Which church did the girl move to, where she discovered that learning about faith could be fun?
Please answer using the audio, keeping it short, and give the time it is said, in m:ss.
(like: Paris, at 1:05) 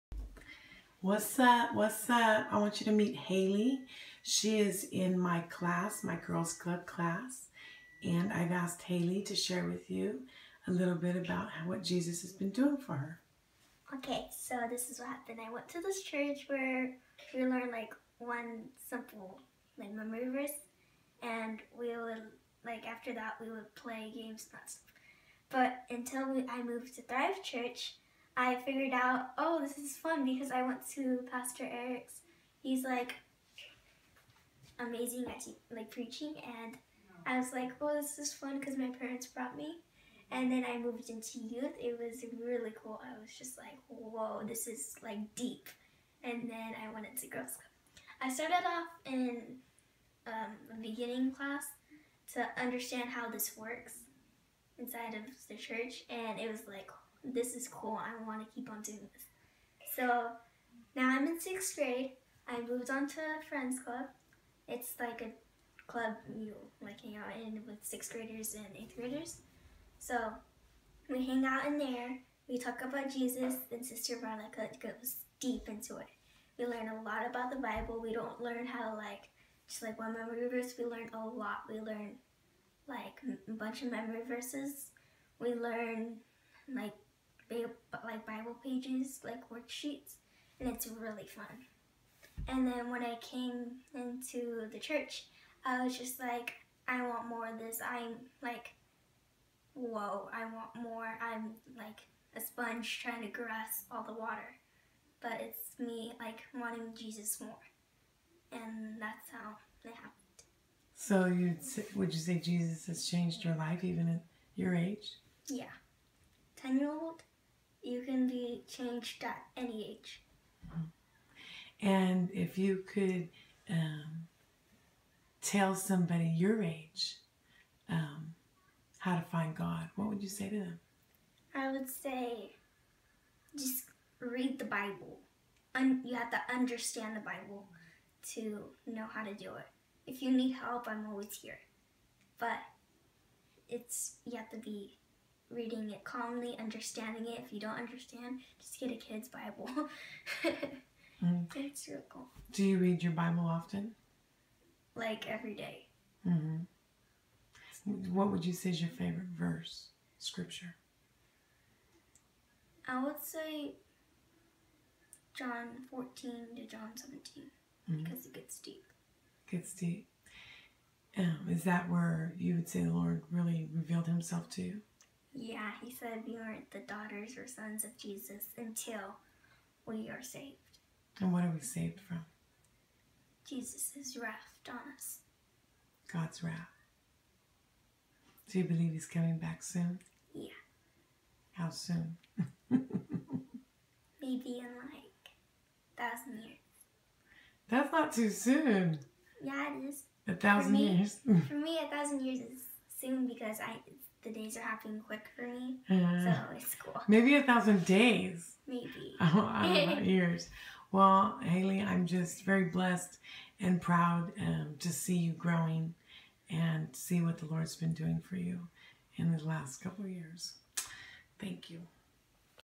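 Thrive Church, at 0:27.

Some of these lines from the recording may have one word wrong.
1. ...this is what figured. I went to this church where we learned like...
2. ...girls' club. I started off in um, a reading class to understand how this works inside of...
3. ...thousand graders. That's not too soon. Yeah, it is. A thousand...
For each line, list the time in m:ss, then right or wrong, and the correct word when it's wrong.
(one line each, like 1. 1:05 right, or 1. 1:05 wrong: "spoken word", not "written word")
1. 0:14 wrong: "happened", not "figured"
2. 0:47 wrong: "beginning", not "reading"
3. 3:15 wrong: "years", not "graders".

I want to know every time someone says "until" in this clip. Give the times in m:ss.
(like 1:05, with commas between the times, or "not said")
0:25, 2:58.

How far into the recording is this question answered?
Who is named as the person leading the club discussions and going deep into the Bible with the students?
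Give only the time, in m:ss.
1:13.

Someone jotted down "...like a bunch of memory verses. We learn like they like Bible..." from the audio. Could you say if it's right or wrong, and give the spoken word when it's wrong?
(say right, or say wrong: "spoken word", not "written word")
right.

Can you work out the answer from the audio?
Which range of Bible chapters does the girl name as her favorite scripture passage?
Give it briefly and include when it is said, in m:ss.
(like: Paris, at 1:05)
John 14 to John 17, at 2:45.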